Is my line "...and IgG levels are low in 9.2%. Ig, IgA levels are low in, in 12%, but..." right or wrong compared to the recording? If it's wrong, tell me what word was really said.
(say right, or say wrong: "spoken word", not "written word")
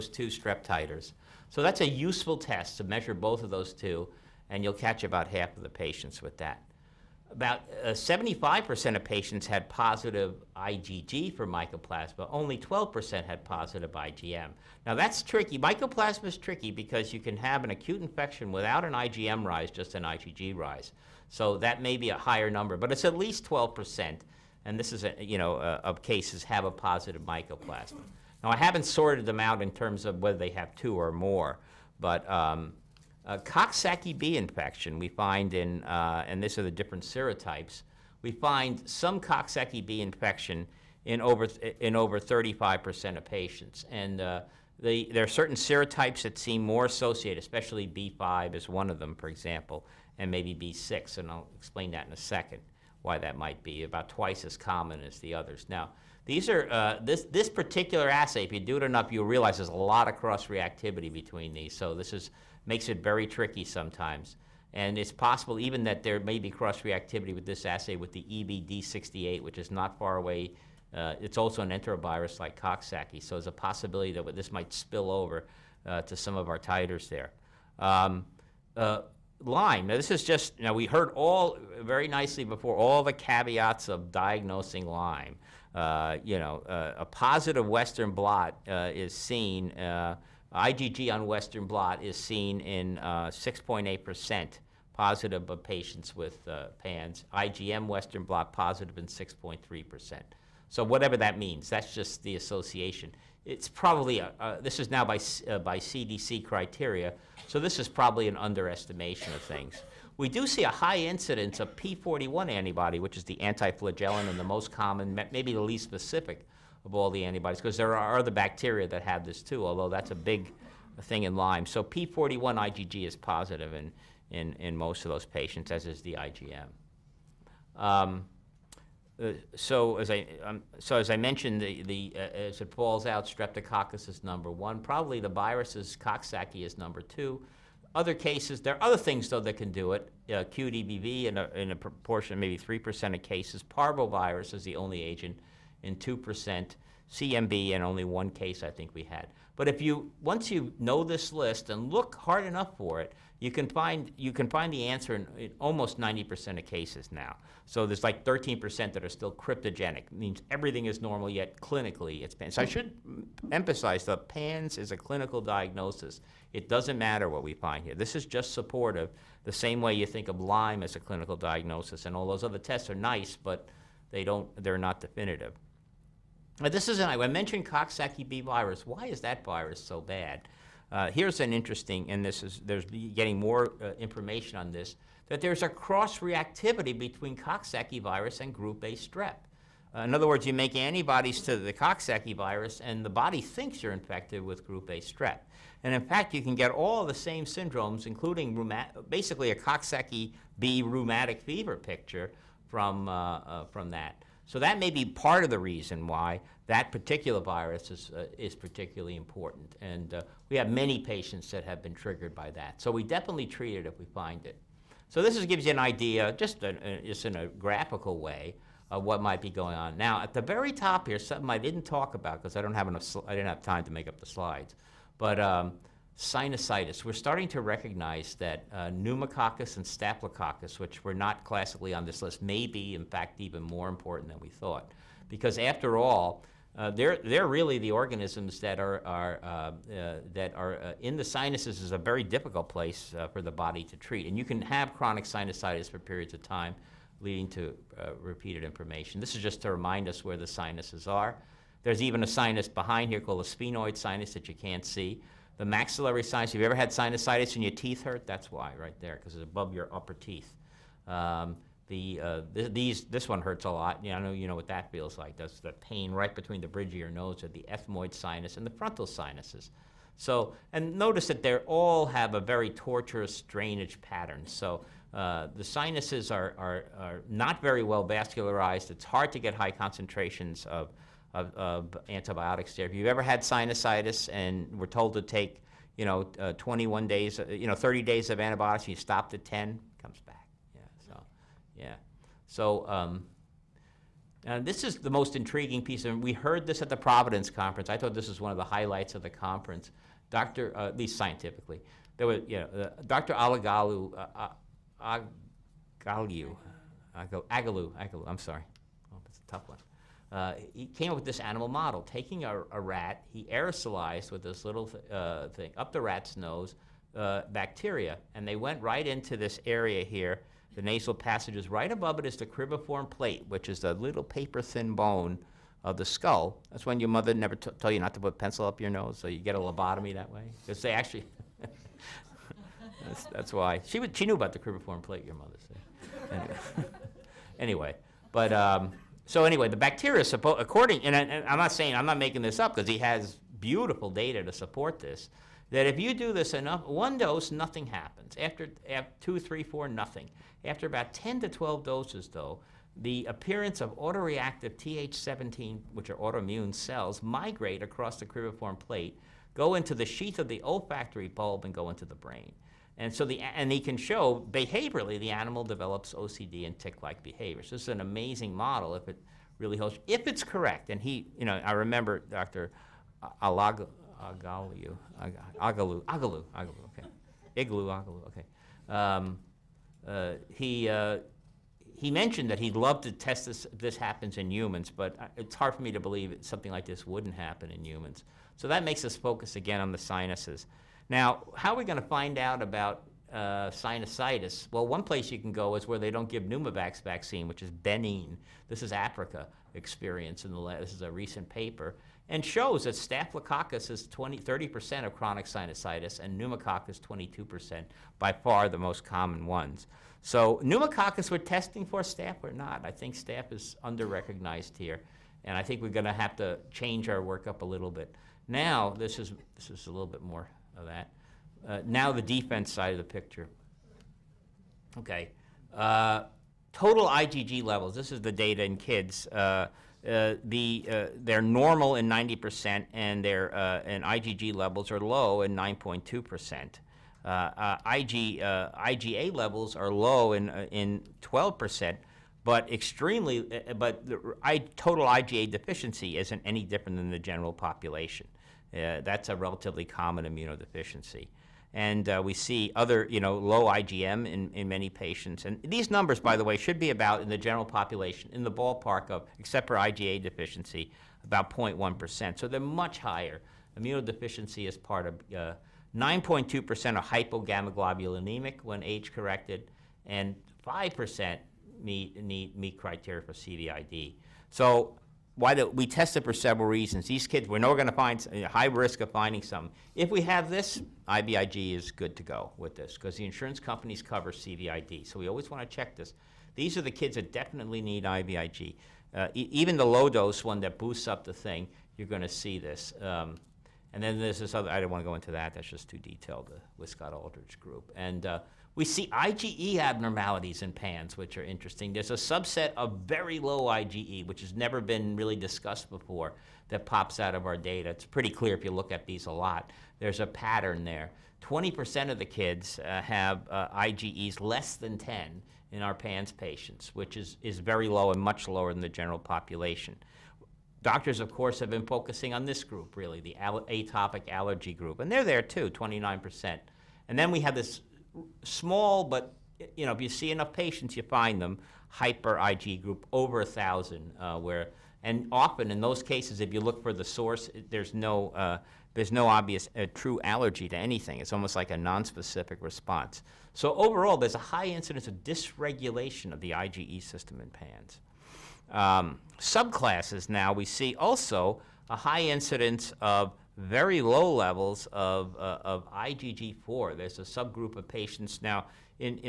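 right.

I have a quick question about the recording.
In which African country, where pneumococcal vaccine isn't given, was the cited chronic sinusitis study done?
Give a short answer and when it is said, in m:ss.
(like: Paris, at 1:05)
Benin, at 6:37.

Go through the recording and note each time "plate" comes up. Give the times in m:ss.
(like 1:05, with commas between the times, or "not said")
5:23, 5:35, 5:58.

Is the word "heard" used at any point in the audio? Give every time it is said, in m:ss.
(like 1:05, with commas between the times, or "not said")
1:20, 4:56.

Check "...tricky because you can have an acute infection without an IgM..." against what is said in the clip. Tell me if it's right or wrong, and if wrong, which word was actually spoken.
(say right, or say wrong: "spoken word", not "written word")
right.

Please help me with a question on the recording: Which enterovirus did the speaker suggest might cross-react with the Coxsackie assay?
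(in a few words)
EV-D68.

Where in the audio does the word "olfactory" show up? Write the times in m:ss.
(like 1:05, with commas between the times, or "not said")
6:00.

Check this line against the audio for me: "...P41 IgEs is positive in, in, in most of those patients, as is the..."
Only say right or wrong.
wrong.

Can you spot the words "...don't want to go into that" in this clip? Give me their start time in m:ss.
8:14.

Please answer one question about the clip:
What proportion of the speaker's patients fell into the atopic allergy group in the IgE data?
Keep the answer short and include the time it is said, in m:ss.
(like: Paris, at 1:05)
29%, at 8:45.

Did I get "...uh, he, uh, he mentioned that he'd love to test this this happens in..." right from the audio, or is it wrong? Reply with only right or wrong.
right.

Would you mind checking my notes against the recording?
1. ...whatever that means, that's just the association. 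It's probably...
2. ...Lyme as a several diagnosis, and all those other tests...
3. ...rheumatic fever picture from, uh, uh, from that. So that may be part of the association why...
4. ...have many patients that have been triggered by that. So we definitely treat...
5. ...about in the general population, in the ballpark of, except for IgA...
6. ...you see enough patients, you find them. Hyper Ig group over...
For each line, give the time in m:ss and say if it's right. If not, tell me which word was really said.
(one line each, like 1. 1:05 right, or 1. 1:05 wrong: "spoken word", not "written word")
1. 1:40 right
2. 2:50 wrong: "clinical", not "several"
3. 3:20 wrong: "reason", not "association"
4. 3:30 right
5. 7:36 right
6. 8:49 right.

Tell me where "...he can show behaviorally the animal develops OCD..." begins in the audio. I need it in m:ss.
6:03.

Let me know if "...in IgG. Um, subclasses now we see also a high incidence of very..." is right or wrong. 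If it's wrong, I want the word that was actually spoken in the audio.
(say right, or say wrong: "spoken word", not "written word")
wrong: "PANS", not "IgG".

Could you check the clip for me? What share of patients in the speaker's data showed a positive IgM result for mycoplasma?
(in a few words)
12%.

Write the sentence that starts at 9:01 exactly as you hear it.
It's almost like a nonspecific response.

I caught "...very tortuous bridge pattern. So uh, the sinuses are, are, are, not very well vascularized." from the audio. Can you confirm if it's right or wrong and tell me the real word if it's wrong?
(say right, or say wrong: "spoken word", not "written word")
wrong: "drainage", not "bridge".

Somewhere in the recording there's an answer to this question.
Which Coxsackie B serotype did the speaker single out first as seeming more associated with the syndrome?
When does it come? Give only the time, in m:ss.
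0:47.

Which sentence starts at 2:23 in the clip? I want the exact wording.
Parvovirus is the only agent and 2% CMV, and only one case I think we had.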